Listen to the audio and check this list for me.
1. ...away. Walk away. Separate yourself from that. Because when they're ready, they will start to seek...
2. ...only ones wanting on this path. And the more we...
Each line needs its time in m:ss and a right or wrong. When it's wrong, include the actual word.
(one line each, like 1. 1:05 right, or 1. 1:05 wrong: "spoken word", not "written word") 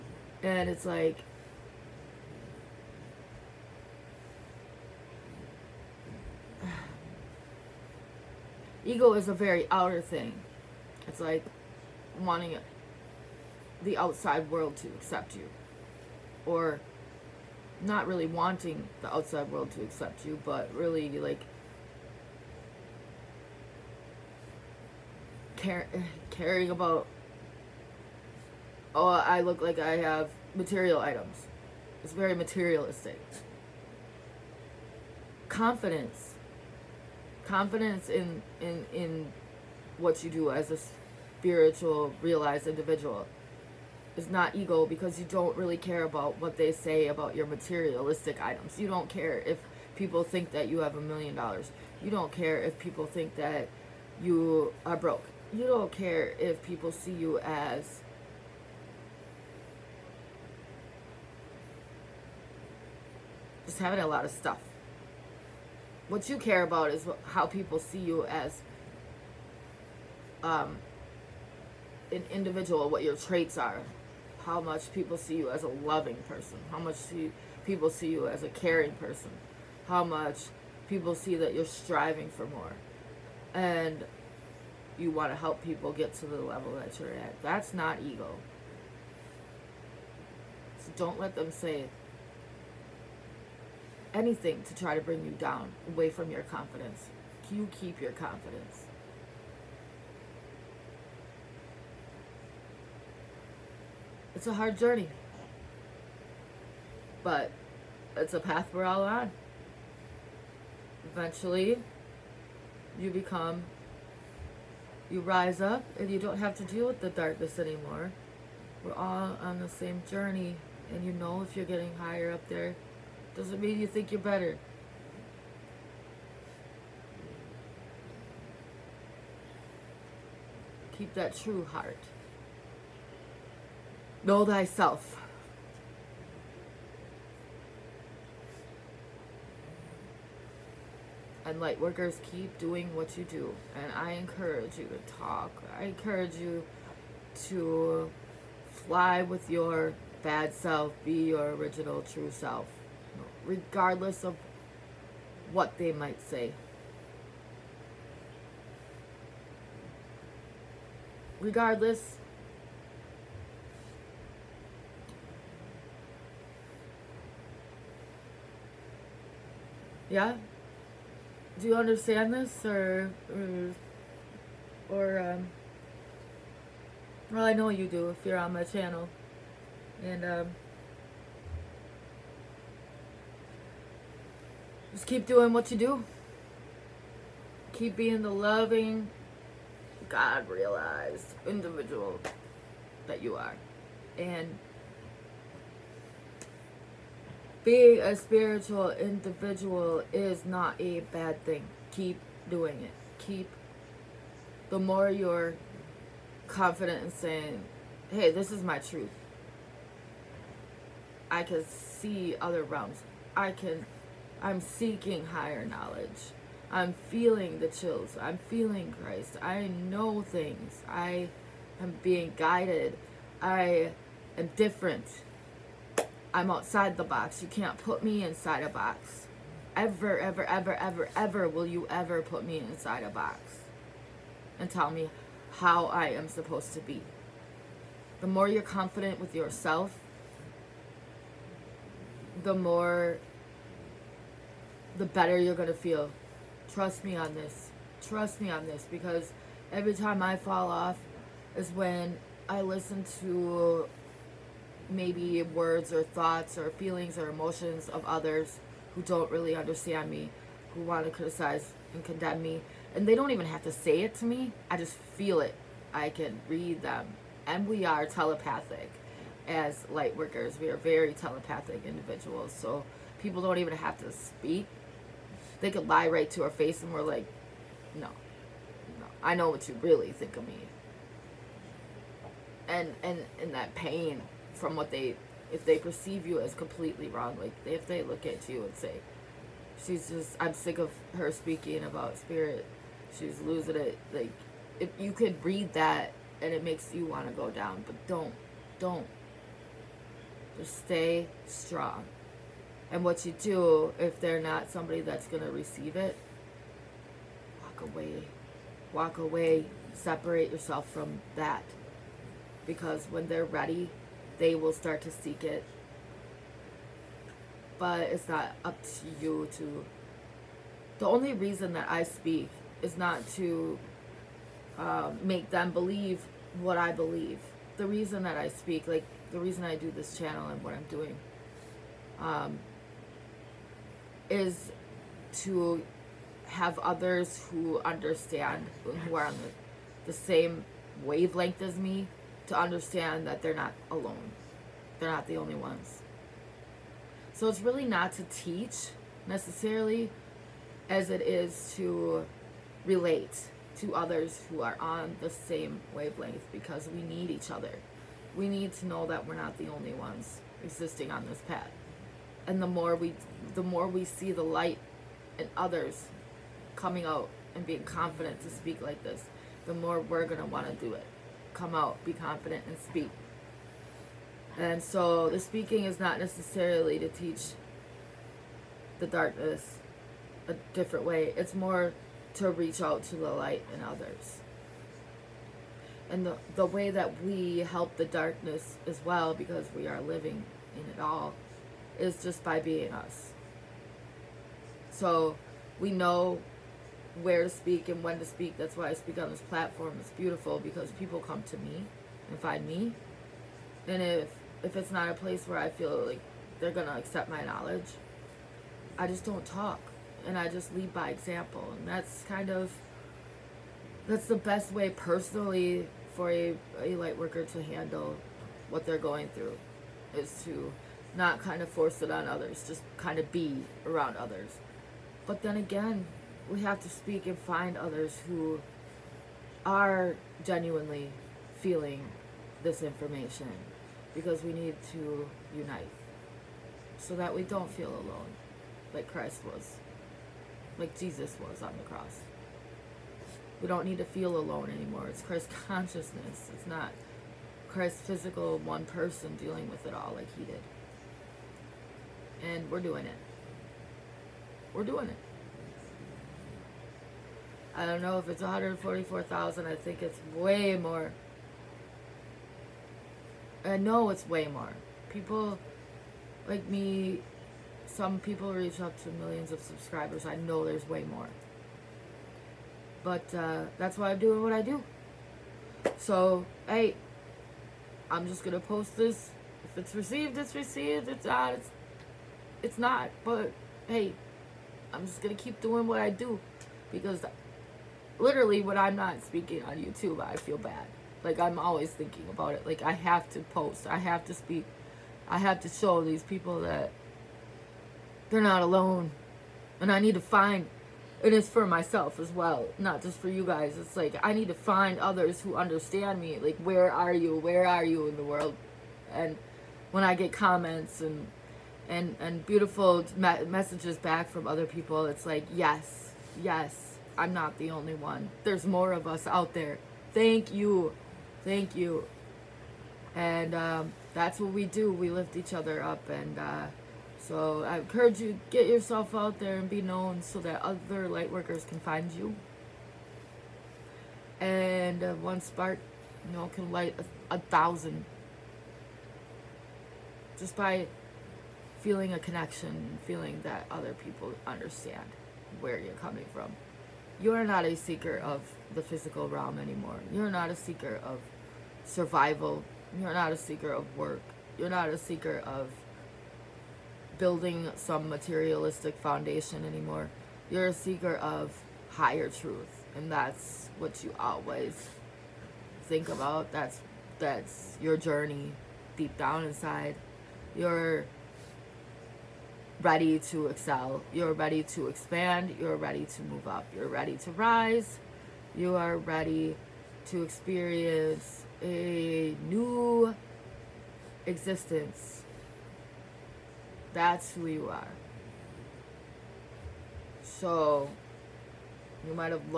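1. 5:07 right
2. 5:59 wrong: "existing", not "wanting".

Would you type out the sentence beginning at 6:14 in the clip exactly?
And so the speaking is not necessarily to teach the darkness a different way.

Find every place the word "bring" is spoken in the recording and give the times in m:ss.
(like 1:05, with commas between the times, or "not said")
1:35.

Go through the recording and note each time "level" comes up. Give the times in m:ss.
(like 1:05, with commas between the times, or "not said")
1:26.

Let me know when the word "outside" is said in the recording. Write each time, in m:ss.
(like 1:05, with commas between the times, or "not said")
0:13, 0:19, 3:46.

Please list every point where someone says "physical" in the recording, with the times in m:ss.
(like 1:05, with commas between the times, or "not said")
7:28, 9:08.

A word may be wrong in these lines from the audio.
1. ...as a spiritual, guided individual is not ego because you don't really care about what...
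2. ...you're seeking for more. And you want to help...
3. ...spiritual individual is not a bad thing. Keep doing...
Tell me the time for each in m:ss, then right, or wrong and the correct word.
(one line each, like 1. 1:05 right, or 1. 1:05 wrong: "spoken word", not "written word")
1. 0:40 wrong: "realized", not "guided"
2. 1:21 wrong: "striving", not "seeking"
3. 3:18 right.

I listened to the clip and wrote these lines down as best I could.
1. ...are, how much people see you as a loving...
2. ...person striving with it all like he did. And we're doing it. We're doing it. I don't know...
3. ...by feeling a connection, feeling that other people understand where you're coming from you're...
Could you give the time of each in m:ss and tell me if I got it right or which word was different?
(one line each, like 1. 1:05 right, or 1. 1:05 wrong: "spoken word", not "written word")
1. 1:13 right
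2. 7:28 wrong: "dealing", not "striving"
3. 9:00 right.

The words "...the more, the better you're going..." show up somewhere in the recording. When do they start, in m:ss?
4:02.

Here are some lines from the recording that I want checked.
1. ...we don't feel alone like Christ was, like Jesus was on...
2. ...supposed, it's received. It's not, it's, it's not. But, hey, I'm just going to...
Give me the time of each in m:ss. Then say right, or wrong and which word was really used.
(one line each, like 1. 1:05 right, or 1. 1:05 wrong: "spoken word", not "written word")
1. 7:17 right
2. 7:59 wrong: "received", not "supposed".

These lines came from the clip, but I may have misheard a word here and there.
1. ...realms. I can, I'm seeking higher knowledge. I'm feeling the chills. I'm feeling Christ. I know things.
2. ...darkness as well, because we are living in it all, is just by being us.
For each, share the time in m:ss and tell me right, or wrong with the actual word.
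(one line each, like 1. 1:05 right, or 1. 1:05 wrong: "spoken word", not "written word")
1. 3:32 right
2. 6:28 right.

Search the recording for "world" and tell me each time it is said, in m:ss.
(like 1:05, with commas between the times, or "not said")
0:14, 0:19, 8:28.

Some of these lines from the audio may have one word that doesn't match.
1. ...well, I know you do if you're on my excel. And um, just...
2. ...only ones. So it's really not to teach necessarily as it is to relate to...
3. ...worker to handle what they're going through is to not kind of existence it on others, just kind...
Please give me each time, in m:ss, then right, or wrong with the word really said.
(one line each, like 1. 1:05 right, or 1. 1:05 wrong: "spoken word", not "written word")
1. 2:57 wrong: "channel", not "excel"
2. 5:45 right
3. 6:57 wrong: "force", not "existence".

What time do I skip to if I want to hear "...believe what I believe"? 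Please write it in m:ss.
5:25.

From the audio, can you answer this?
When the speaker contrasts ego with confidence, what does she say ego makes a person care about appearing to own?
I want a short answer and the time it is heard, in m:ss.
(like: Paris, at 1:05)
material items, at 0:30.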